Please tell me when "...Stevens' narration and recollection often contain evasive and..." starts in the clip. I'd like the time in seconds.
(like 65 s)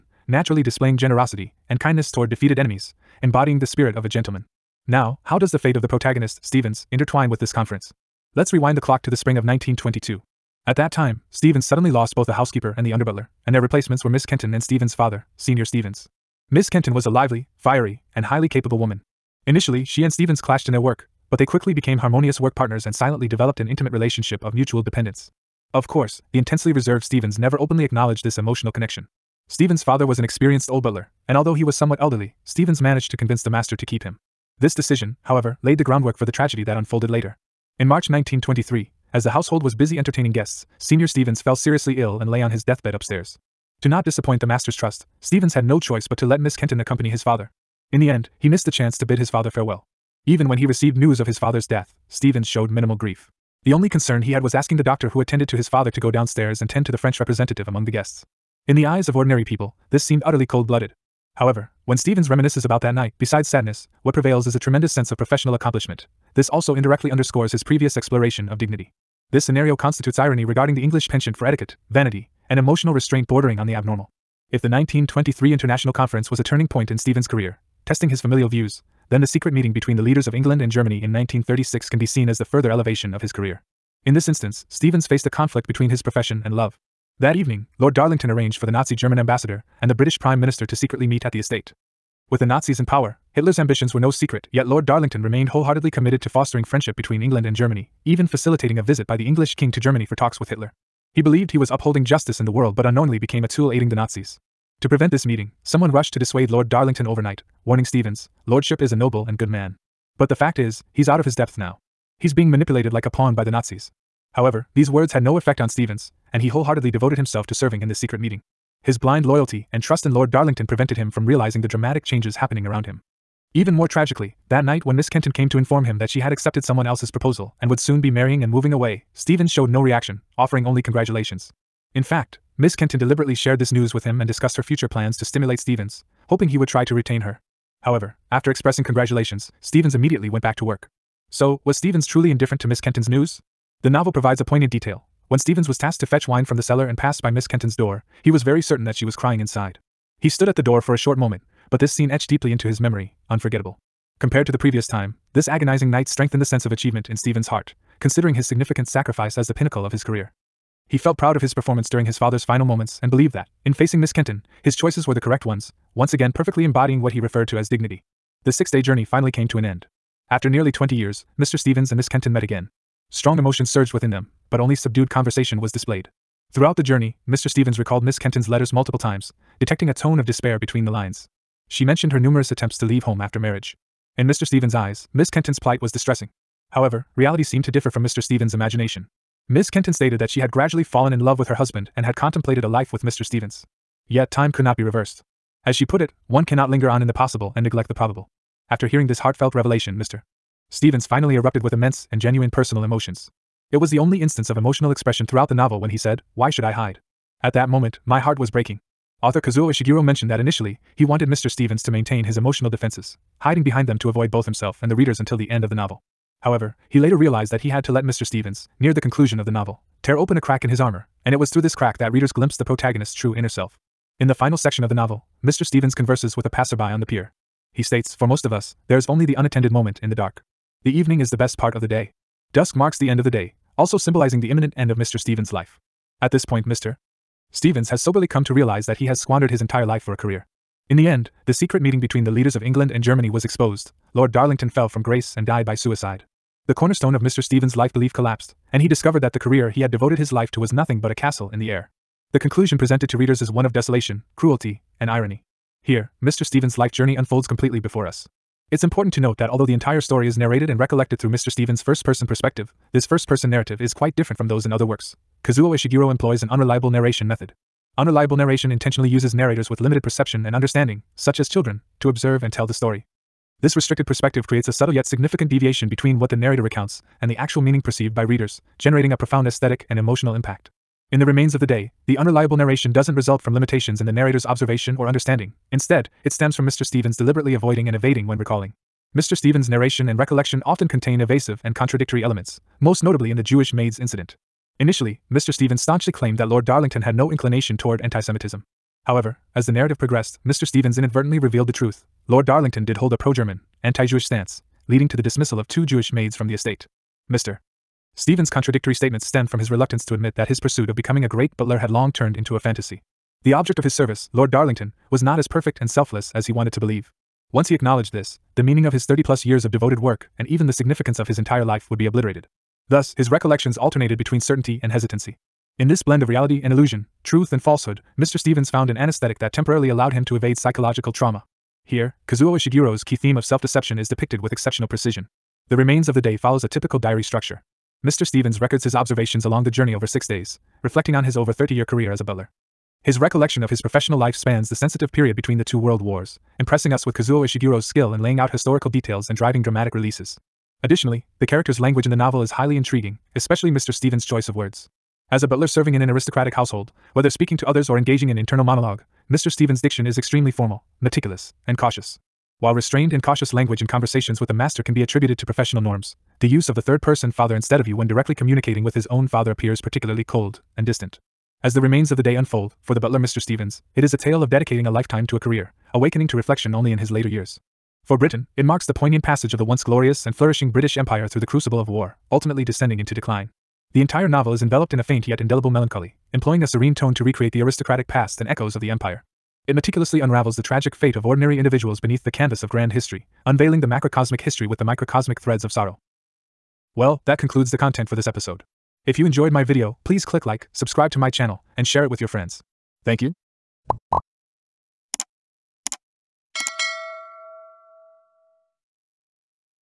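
289 s.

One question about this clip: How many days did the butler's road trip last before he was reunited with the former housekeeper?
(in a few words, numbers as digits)
6.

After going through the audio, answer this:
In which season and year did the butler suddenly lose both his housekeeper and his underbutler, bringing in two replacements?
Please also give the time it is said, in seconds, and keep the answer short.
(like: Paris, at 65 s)
Spring of 1922, at 9 s.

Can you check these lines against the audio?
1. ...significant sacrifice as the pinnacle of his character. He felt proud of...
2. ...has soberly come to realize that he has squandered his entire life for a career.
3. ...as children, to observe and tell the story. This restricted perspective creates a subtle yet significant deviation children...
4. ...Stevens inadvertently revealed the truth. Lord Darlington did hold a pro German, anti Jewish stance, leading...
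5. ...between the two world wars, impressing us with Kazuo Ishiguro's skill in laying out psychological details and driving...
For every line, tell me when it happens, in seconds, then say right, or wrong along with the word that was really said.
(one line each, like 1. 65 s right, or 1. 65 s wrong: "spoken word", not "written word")
1. 158 s wrong: "career", not "character"
2. 237 s right
3. 271 s wrong: "between", not "children"
4. 300 s right
5. 345 s wrong: "historical", not "psychological".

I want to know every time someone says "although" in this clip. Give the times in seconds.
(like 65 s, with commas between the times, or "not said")
31 s, 259 s.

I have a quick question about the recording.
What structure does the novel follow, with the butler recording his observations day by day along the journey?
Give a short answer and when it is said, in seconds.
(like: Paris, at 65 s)
Diary structure, at 336 s.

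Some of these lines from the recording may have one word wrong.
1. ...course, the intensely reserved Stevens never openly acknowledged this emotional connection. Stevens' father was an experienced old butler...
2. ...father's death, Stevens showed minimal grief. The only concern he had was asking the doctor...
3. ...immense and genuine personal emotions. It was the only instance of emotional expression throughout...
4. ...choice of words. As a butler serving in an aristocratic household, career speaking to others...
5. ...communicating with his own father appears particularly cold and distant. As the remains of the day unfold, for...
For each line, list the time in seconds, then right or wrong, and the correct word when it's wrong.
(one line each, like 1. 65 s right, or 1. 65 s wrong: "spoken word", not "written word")
1. 25 s right
2. 51 s right
3. 201 s right
4. 354 s wrong: "whether", not "career"
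5. 368 s right.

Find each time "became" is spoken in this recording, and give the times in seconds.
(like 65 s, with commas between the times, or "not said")
21 s, 103 s.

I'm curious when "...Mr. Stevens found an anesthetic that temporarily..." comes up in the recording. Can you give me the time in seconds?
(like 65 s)
328 s.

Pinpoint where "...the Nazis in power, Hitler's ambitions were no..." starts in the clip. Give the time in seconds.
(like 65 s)
92 s.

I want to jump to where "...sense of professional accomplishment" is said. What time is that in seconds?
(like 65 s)
64 s.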